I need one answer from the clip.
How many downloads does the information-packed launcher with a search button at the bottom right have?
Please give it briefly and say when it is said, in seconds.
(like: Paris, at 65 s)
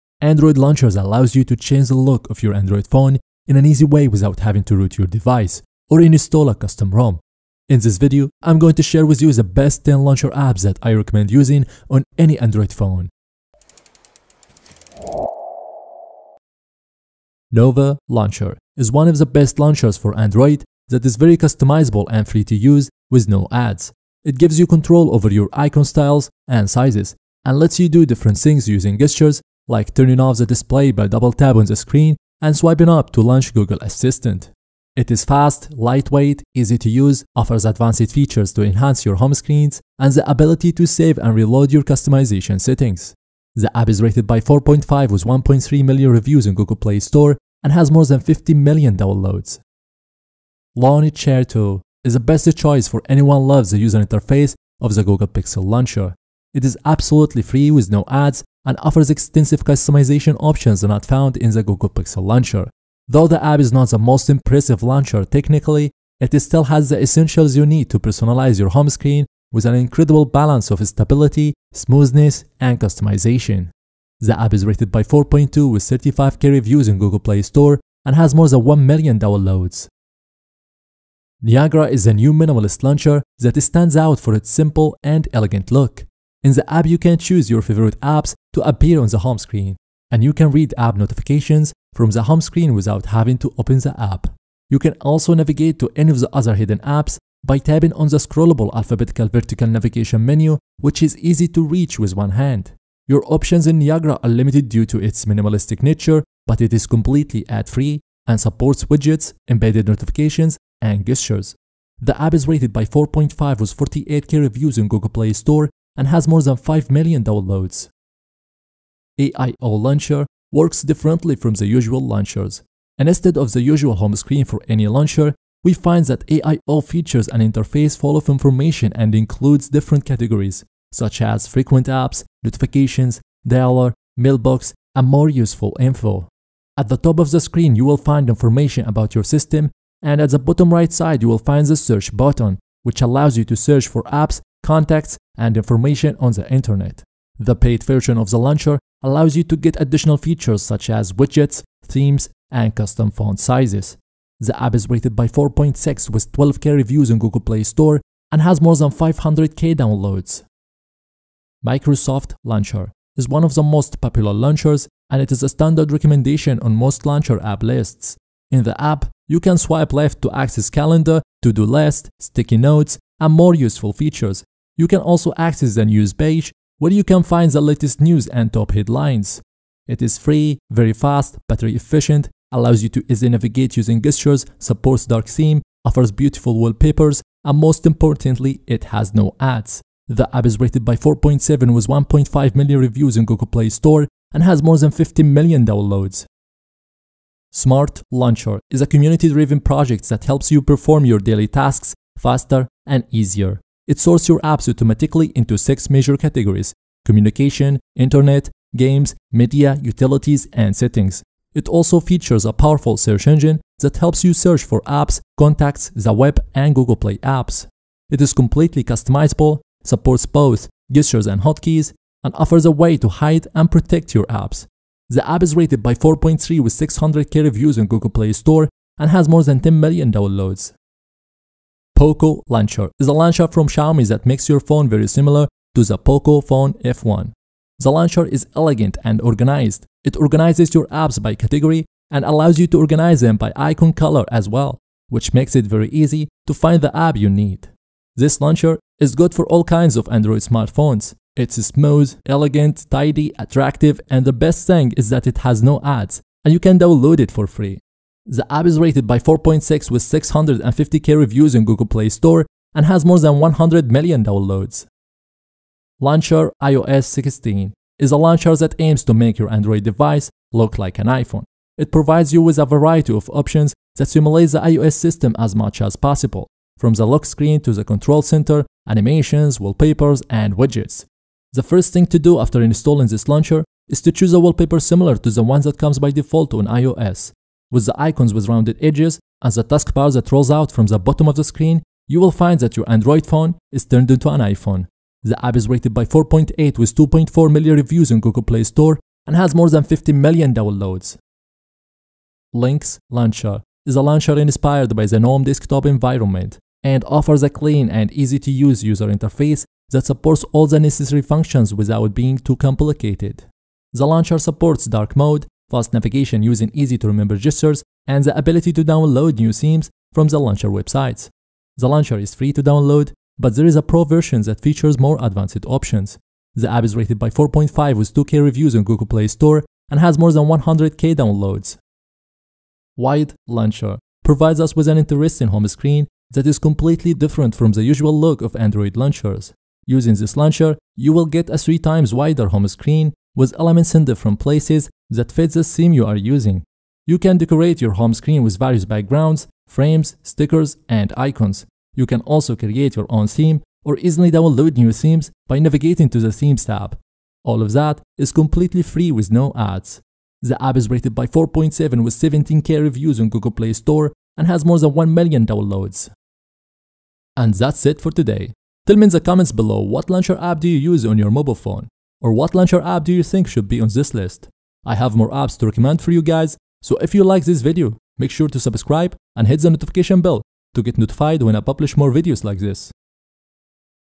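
500k, at 158 s.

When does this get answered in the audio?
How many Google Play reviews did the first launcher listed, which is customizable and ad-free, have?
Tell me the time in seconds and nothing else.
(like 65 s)
45 s.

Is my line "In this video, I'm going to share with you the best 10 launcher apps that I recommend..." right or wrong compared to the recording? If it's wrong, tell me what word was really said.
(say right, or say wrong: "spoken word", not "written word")
right.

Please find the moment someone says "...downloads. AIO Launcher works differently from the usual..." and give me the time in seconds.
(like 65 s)
117 s.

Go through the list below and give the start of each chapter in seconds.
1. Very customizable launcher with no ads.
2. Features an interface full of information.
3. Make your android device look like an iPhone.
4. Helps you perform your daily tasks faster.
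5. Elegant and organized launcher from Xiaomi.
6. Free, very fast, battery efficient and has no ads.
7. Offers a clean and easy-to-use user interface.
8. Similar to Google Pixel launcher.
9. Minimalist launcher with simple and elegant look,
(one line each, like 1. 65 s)
1. 17 s
2. 118 s
3. 265 s
4. 197 s
5. 231 s
6. 160 s
7. 301 s
8. 50 s
9. 80 s.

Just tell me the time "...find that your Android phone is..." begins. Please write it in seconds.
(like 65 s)
292 s.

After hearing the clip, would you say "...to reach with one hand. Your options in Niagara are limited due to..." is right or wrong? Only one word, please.
right.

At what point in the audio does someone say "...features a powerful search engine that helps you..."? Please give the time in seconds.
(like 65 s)
211 s.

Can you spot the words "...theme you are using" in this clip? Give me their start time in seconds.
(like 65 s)
345 s.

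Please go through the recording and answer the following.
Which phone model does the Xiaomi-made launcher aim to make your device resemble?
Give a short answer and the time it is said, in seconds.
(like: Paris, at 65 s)
Poco Phone F1, at 235 s.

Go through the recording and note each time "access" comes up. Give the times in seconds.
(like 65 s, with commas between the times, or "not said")
170 s, 175 s.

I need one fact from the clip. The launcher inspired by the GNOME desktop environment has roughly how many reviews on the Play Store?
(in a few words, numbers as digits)
2k.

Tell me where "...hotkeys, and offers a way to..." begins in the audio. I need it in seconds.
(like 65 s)
221 s.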